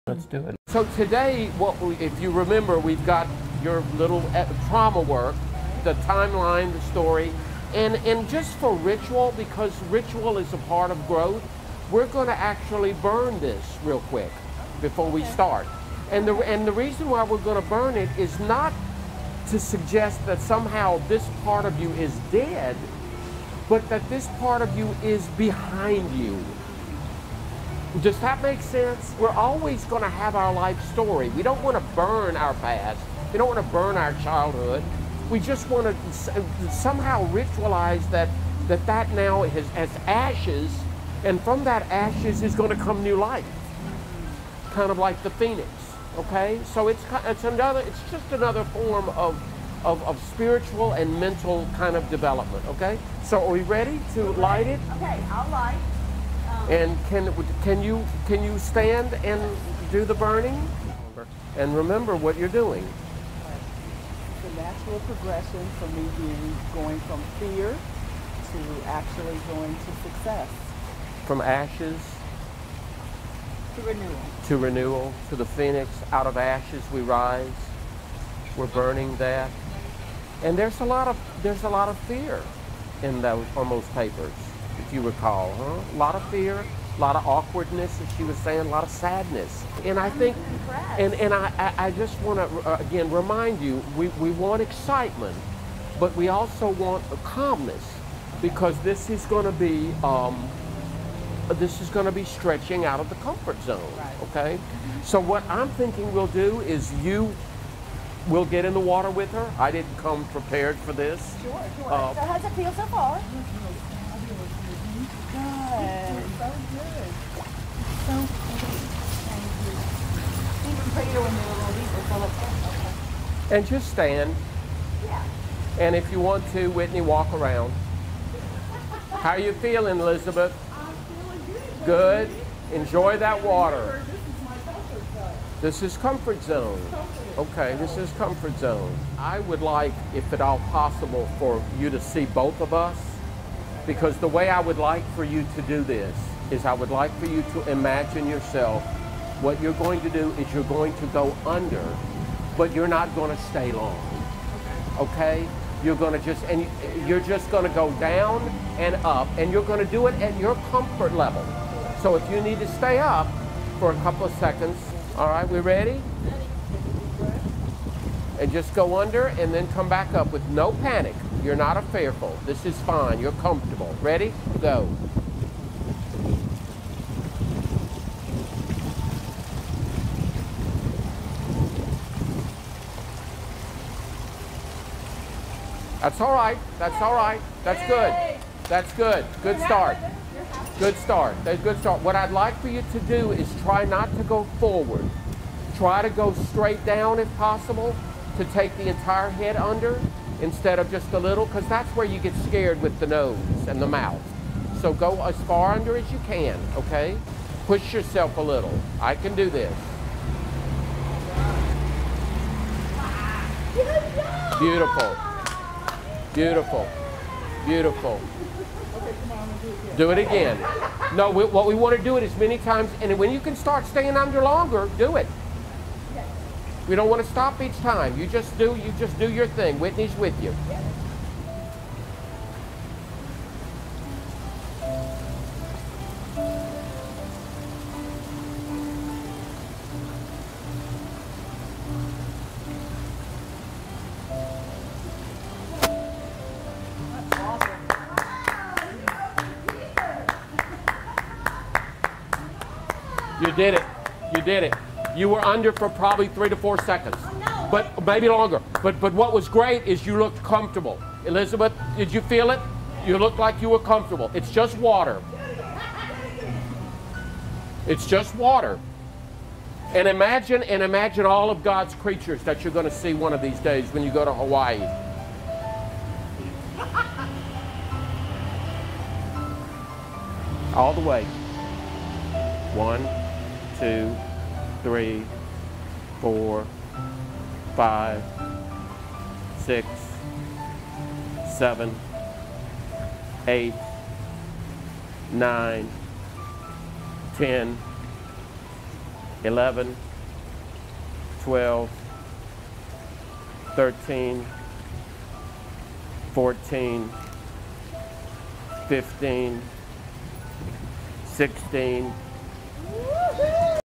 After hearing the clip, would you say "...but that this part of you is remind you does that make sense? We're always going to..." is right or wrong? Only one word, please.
wrong.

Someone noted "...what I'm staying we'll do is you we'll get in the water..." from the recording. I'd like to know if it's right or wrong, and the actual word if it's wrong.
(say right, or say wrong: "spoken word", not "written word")
wrong: "thinking", not "staying".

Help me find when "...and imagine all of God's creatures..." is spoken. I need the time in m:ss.
4:30.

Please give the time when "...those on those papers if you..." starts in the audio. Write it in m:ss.
1:23.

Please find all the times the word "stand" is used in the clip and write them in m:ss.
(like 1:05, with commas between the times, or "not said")
0:58, 2:03.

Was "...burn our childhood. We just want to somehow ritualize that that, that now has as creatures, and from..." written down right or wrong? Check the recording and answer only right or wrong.
wrong.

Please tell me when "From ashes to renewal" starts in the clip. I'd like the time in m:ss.
1:11.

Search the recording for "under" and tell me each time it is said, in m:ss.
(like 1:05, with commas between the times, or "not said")
2:31, 2:48, 3:19, 3:25, 3:44, 4:15.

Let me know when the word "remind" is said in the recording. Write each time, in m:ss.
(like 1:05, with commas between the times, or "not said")
1:33.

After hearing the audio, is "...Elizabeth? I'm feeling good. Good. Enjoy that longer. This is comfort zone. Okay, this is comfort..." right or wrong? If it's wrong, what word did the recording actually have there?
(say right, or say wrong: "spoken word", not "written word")
wrong: "water", not "longer".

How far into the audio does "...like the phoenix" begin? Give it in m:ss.
0:44.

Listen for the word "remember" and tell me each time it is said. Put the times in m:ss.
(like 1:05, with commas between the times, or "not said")
0:02, 1:01.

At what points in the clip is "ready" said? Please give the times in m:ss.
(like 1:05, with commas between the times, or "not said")
0:53, 2:45, 2:54.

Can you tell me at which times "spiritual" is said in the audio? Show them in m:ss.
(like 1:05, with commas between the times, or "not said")
0:50.